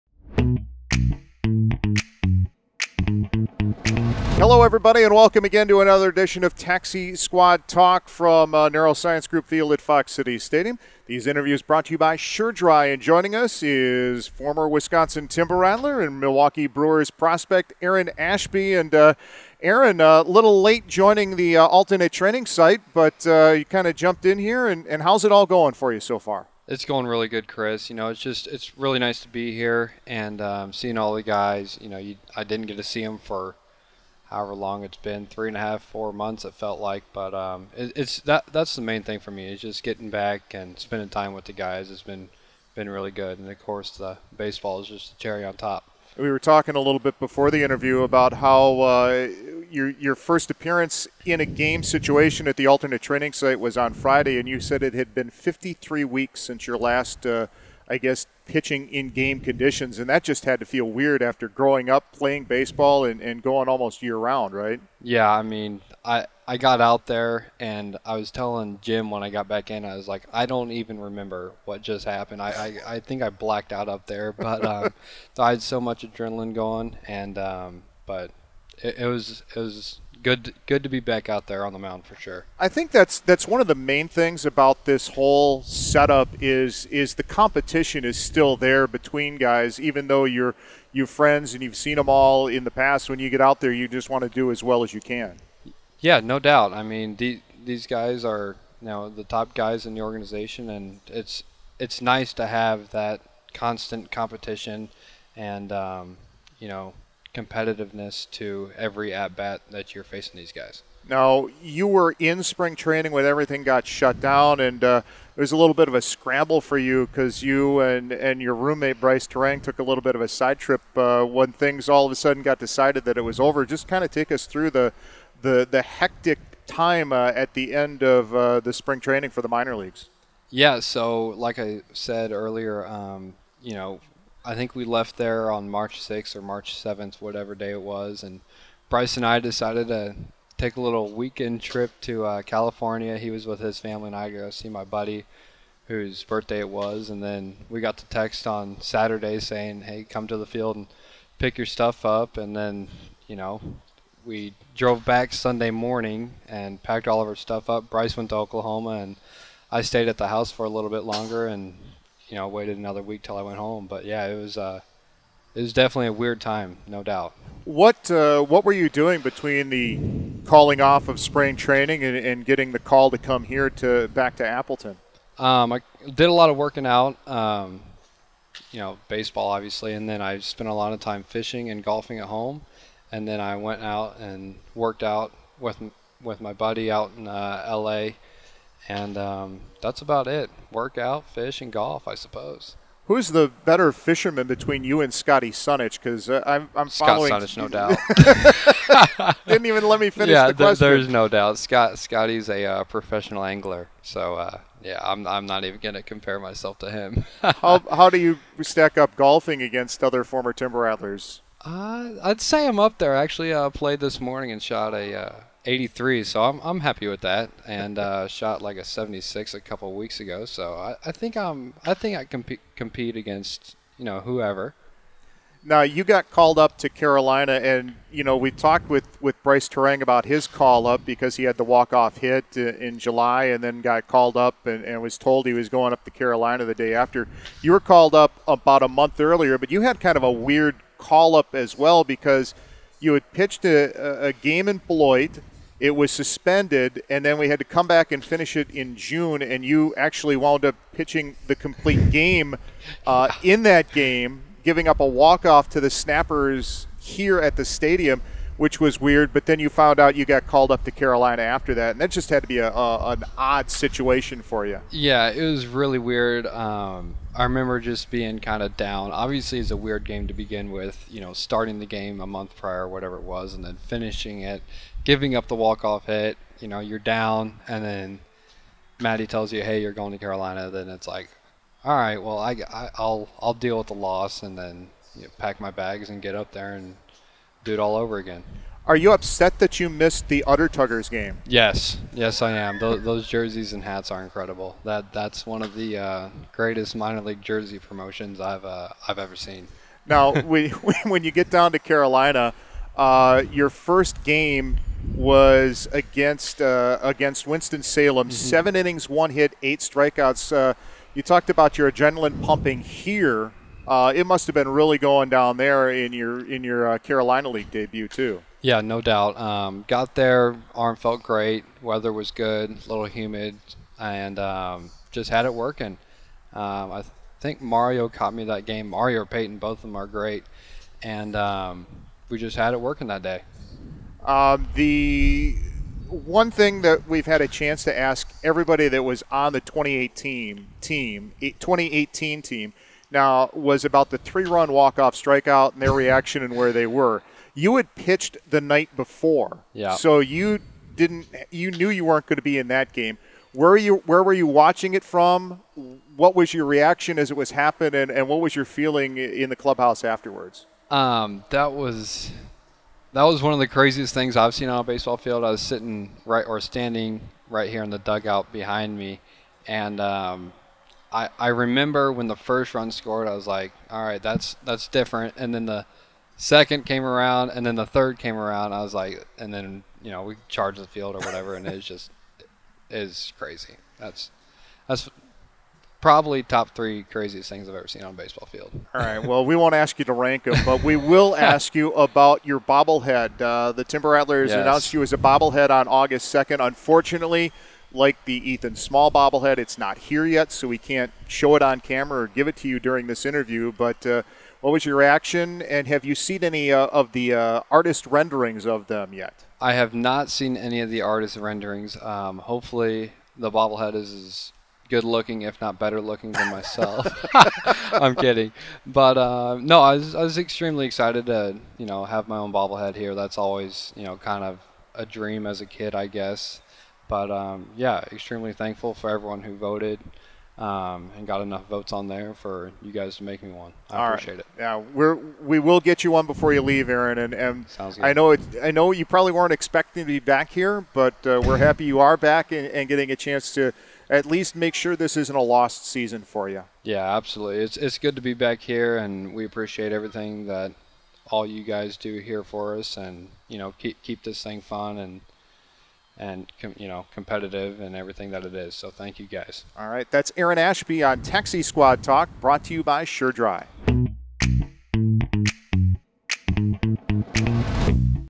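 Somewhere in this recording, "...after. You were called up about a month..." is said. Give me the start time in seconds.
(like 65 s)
236 s.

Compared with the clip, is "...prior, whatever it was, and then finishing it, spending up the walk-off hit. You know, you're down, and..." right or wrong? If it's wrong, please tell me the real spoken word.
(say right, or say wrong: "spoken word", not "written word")
wrong: "giving", not "spending".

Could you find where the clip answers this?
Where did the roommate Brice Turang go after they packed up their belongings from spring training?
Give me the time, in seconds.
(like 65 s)
158 s.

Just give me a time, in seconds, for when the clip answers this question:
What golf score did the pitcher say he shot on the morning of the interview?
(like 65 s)
215 s.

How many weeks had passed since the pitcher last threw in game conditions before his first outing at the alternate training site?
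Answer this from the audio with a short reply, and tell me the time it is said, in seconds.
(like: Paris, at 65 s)
53, at 55 s.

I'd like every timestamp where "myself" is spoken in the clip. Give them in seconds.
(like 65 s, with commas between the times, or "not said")
206 s, 416 s.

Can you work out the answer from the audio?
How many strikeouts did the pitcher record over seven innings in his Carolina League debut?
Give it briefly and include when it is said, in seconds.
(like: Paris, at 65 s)
8, at 309 s.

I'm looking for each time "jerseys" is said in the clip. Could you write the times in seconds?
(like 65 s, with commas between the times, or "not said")
293 s, 297 s.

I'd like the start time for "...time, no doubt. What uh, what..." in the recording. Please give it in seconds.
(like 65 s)
166 s.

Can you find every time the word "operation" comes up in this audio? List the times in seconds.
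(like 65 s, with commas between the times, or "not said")
not said.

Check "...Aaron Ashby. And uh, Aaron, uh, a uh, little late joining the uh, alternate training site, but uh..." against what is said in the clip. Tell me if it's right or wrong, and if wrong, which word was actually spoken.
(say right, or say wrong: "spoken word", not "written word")
right.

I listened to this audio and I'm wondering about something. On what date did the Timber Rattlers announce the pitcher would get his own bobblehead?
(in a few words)
August 2nd.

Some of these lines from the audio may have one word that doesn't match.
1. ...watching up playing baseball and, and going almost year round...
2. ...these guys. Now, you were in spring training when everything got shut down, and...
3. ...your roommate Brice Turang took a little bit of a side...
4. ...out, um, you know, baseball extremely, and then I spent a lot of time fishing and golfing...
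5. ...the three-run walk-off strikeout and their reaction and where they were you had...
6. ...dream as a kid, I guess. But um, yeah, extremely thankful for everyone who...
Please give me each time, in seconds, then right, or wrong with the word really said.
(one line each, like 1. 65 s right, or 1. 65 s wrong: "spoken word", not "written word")
1. 61 s wrong: "growing", not "watching"
2. 110 s right
3. 118 s right
4. 176 s wrong: "obviously", not "extremely"
5. 344 s right
6. 425 s right.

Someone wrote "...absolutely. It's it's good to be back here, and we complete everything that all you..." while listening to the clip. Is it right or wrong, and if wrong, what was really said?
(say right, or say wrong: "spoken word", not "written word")
wrong: "appreciate", not "complete".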